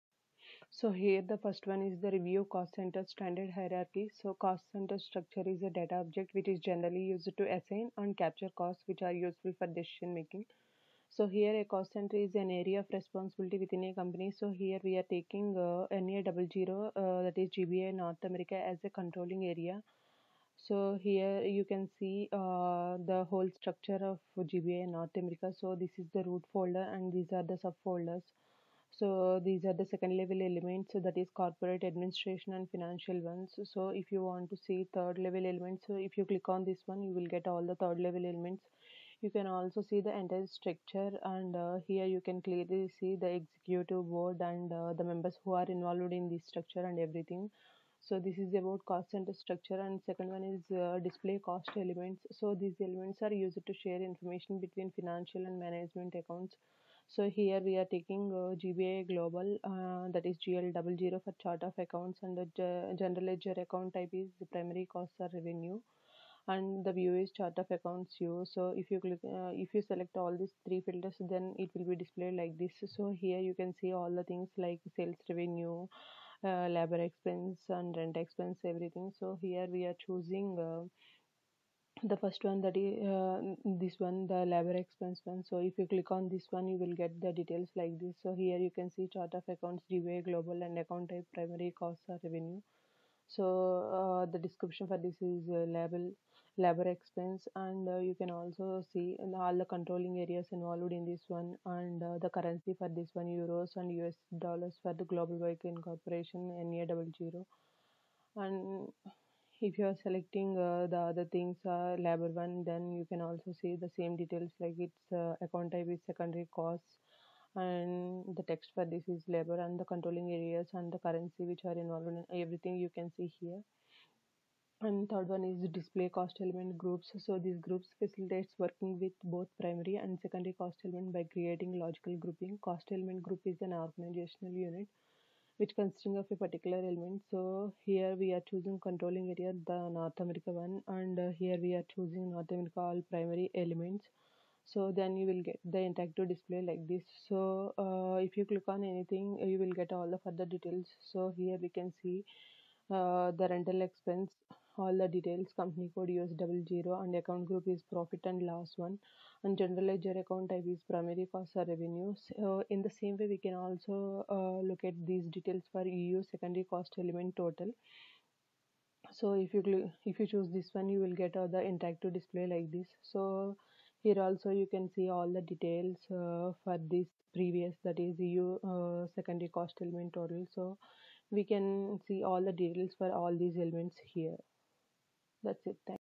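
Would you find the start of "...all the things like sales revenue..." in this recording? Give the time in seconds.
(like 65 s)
73 s.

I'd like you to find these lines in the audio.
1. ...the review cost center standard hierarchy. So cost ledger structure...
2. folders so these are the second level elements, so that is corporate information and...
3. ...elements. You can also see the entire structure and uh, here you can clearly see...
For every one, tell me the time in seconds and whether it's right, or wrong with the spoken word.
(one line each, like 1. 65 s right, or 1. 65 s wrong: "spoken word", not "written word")
1. 2 s wrong: "center", not "ledger"
2. 28 s wrong: "administration", not "information"
3. 38 s right.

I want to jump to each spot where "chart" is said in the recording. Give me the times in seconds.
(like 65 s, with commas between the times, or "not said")
61 s, 67 s, 89 s.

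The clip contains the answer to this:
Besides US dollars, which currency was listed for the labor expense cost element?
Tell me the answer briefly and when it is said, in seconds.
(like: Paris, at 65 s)
Euros, at 103 s.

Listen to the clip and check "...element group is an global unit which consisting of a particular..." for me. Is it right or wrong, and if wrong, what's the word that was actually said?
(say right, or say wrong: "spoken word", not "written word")
wrong: "organizational", not "global".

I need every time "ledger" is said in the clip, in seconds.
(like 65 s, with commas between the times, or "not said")
63 s, 159 s.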